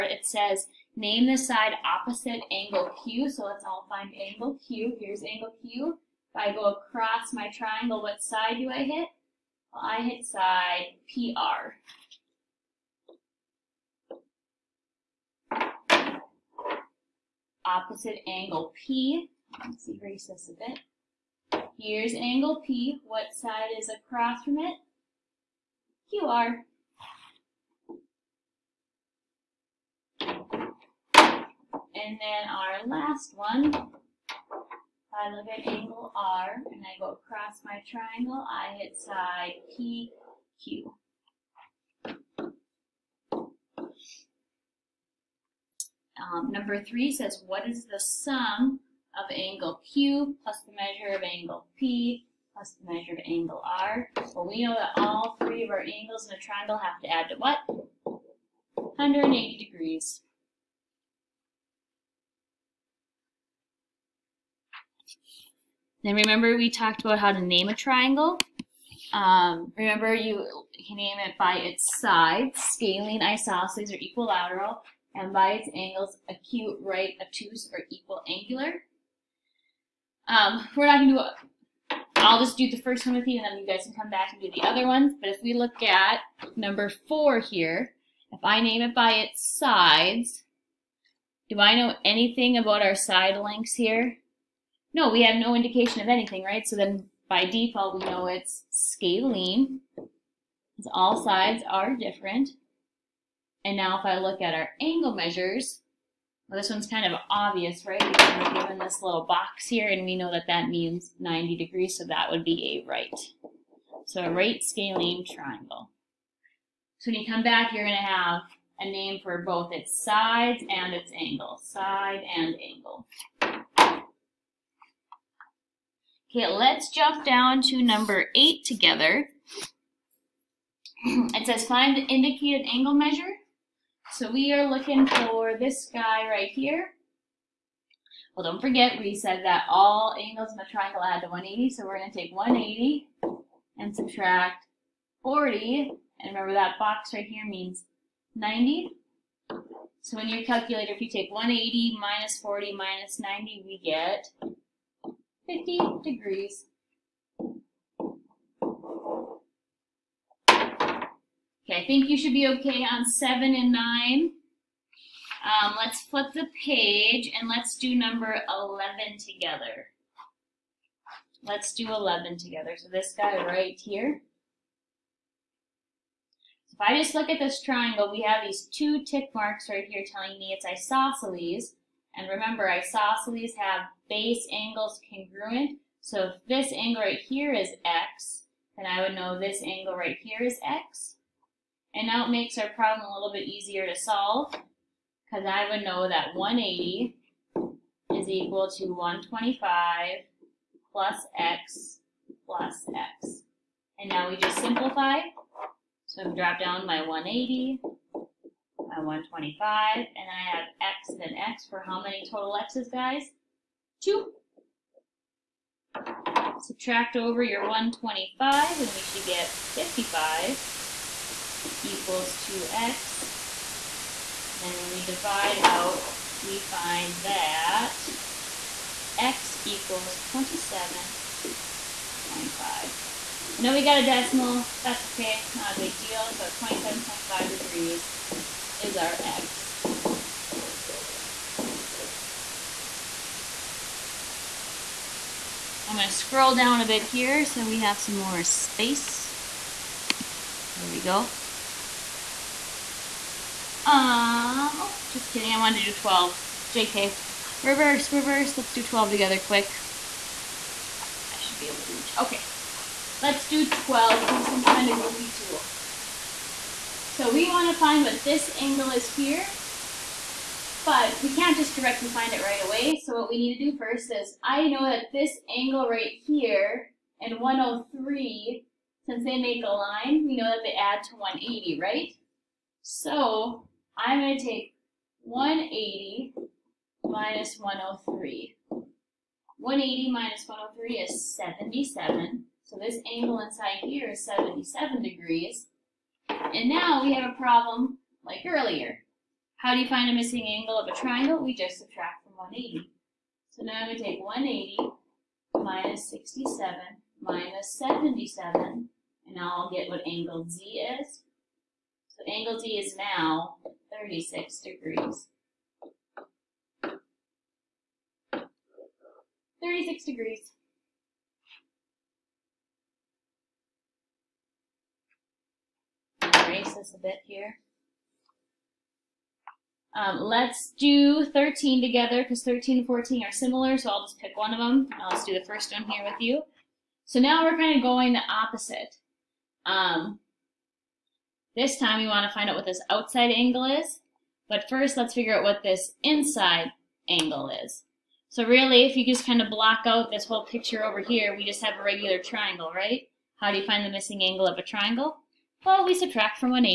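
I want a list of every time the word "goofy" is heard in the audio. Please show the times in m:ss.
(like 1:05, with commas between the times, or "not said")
4:25.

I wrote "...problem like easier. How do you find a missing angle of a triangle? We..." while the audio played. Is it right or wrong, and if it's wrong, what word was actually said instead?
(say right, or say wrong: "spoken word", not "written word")
wrong: "earlier", not "easier".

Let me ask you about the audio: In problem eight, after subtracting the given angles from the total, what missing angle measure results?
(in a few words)
50 degrees.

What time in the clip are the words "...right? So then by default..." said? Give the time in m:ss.
1:36.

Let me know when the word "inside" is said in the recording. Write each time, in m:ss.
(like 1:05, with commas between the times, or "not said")
4:53, 5:46.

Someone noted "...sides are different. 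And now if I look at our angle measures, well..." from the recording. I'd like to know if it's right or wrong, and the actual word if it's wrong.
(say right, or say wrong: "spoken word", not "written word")
right.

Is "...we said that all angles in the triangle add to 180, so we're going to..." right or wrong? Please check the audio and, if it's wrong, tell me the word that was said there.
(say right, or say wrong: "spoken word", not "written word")
right.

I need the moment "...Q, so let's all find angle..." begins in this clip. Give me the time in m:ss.
0:03.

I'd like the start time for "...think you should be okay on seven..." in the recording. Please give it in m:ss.
2:41.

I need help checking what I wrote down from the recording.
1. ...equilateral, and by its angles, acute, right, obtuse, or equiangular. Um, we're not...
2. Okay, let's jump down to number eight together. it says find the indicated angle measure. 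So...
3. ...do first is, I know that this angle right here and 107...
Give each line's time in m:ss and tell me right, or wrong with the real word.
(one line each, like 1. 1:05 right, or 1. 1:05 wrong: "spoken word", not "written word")
1. 1:13 right
2. 2:06 right
3. 4:33 wrong: "103", not "107".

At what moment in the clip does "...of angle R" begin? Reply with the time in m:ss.
0:53.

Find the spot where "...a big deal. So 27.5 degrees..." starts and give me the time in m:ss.
3:55.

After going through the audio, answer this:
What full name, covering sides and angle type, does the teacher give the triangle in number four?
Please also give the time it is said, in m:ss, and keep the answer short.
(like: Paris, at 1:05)
right scalene triangle, at 1:54.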